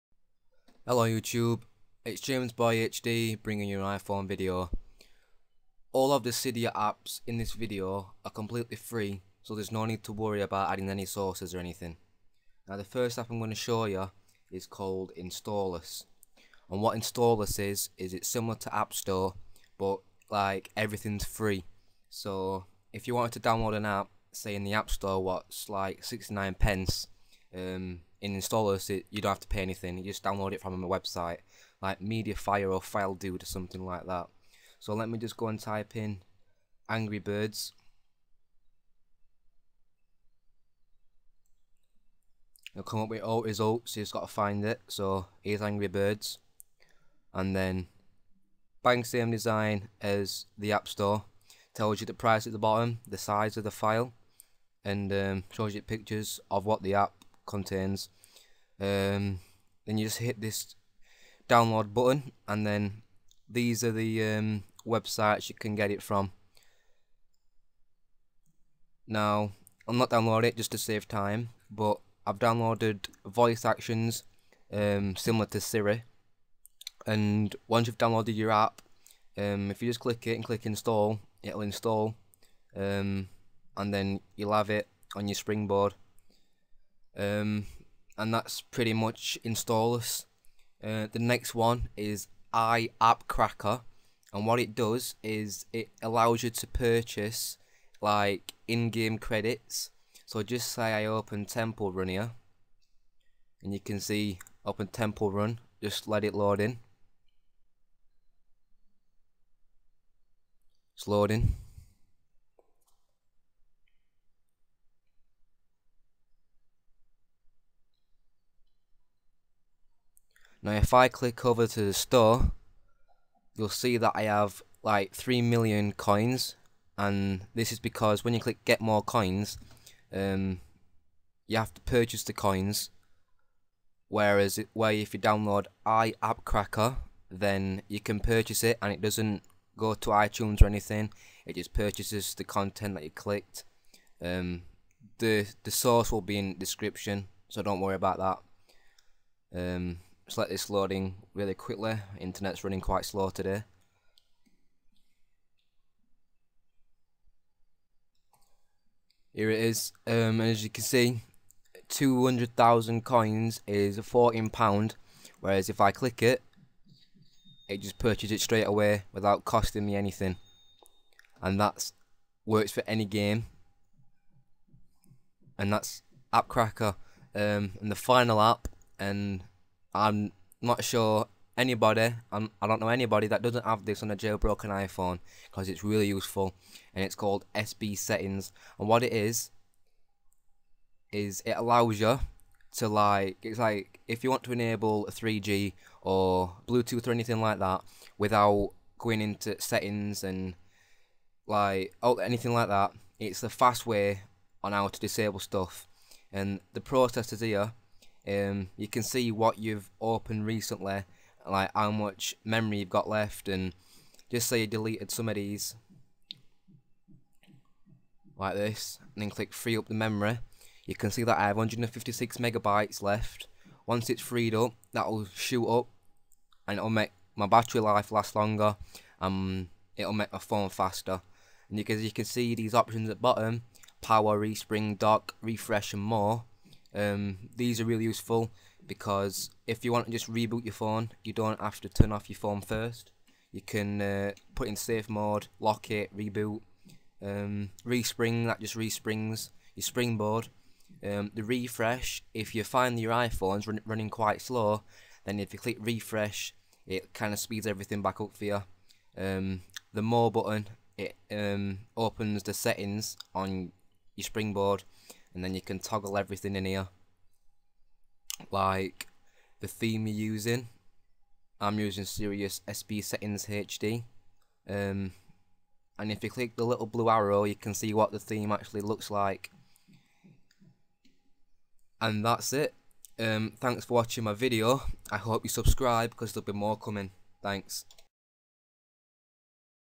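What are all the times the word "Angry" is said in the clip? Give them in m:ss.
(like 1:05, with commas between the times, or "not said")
0:36, 0:45.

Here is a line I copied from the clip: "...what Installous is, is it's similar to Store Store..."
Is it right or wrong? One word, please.
wrong.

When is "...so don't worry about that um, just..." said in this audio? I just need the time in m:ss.
2:27.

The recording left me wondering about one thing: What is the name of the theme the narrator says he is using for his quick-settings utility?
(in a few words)
Sirius SB Settings HD.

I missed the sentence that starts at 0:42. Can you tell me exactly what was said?
It'll come up with all results, you just gotta find it.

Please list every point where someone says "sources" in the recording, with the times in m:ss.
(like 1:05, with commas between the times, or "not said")
0:11, 2:25.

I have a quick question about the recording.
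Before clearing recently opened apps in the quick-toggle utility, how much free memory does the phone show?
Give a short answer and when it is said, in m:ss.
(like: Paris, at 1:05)
156 megabytes, at 3:41.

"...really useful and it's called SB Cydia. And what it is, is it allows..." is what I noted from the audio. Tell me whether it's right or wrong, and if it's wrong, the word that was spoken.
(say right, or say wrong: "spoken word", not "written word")
wrong: "Settings", not "Cydia".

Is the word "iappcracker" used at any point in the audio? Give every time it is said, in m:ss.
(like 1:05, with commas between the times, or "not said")
1:32, 2:15.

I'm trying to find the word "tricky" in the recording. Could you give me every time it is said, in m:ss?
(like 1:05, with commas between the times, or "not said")
not said.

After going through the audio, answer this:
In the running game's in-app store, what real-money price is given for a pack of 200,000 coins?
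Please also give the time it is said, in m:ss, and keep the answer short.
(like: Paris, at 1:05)
£14, at 2:43.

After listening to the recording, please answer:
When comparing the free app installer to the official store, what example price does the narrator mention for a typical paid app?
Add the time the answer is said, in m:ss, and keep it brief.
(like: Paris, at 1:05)
69 pence, at 0:26.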